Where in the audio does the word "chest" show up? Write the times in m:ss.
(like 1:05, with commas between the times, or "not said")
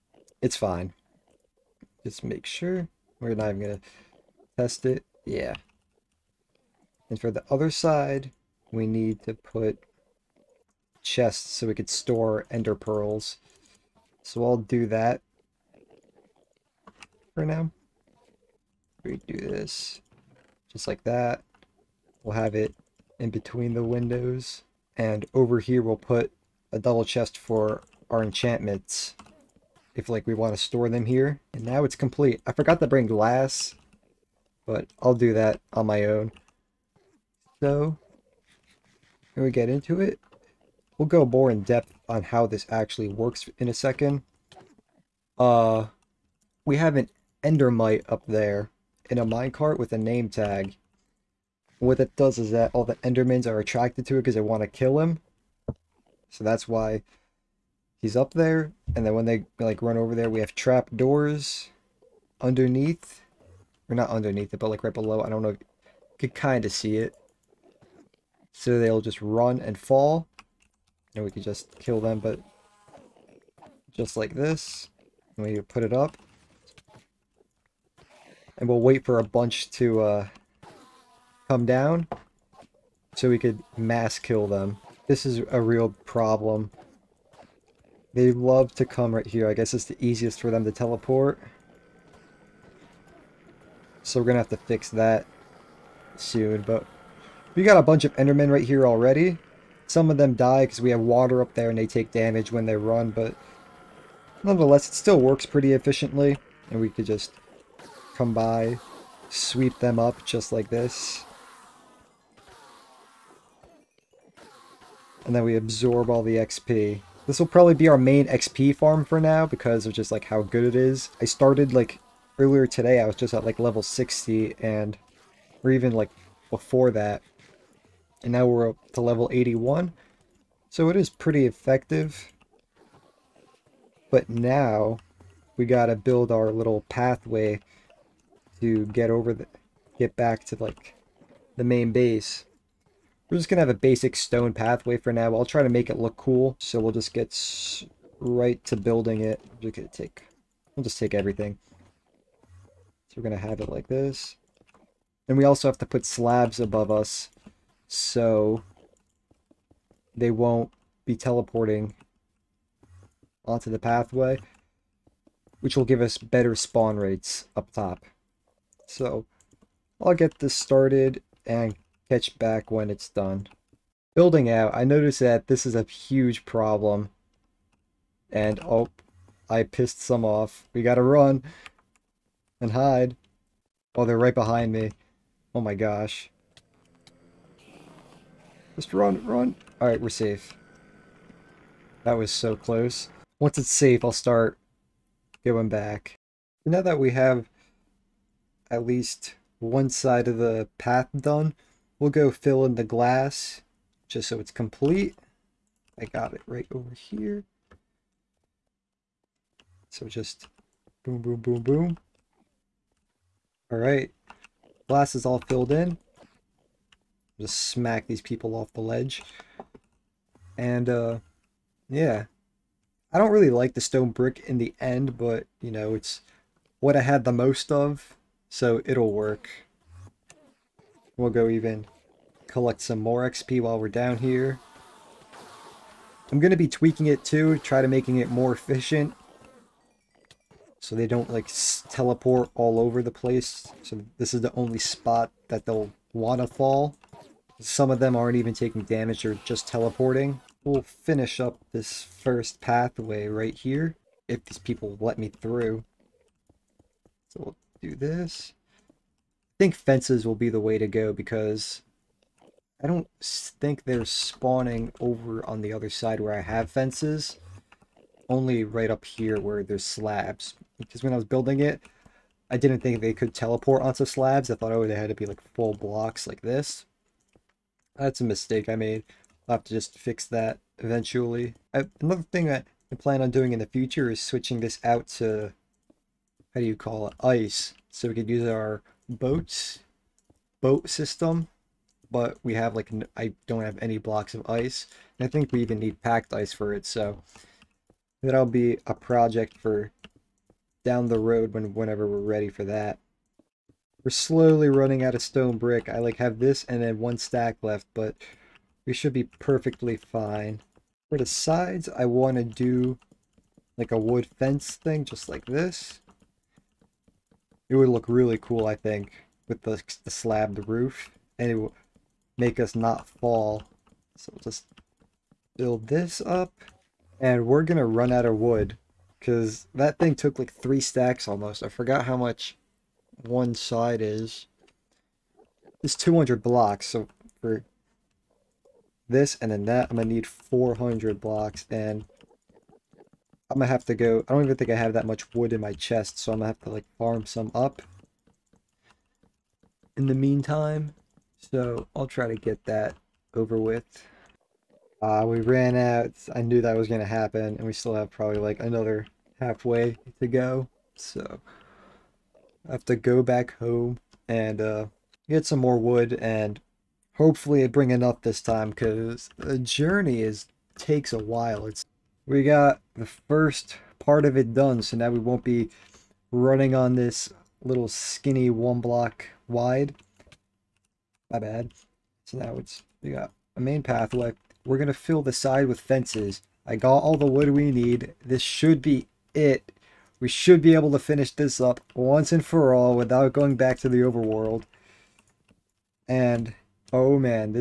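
0:11, 0:27, 5:45.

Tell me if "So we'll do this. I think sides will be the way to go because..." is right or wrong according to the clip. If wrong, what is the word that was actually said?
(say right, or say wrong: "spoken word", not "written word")
wrong: "fences", not "sides".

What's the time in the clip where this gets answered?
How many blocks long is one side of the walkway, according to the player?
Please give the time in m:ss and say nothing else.
5:35.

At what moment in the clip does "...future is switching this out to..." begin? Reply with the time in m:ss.
4:43.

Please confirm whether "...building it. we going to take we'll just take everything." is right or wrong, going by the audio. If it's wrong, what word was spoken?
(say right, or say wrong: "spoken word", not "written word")
right.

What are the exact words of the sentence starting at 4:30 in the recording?
Because when I was building it, I didn't think they could teleport onto slabs.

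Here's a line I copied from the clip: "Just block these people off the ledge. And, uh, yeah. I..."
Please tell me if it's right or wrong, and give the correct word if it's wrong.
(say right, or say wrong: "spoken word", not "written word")
wrong: "smack", not "block".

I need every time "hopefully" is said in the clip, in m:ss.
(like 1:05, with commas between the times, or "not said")
6:07.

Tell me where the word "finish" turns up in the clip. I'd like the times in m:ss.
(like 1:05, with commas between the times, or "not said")
4:10, 6:31.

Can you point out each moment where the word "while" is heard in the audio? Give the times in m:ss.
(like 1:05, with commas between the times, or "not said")
3:53, 6:11.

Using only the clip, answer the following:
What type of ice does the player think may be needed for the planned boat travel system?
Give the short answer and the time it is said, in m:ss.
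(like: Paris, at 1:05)
Packed ice, at 4:56.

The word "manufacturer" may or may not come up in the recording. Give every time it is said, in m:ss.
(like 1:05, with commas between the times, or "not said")
not said.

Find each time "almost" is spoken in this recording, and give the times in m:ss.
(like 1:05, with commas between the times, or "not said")
5:31.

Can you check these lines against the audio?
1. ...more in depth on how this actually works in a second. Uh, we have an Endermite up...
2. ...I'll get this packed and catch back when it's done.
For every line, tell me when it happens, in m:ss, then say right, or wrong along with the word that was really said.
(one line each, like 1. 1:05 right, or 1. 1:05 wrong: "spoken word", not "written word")
1. 0:41 right
2. 2:50 wrong: "started", not "packed".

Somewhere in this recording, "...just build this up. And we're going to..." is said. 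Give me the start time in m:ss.
5:24.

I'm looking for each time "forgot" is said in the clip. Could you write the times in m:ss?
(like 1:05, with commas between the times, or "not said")
0:32, 5:31.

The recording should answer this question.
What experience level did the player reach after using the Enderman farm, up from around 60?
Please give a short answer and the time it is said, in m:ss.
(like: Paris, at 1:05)
81, at 2:09.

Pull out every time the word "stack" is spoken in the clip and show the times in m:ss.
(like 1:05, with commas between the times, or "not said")
5:07, 5:30.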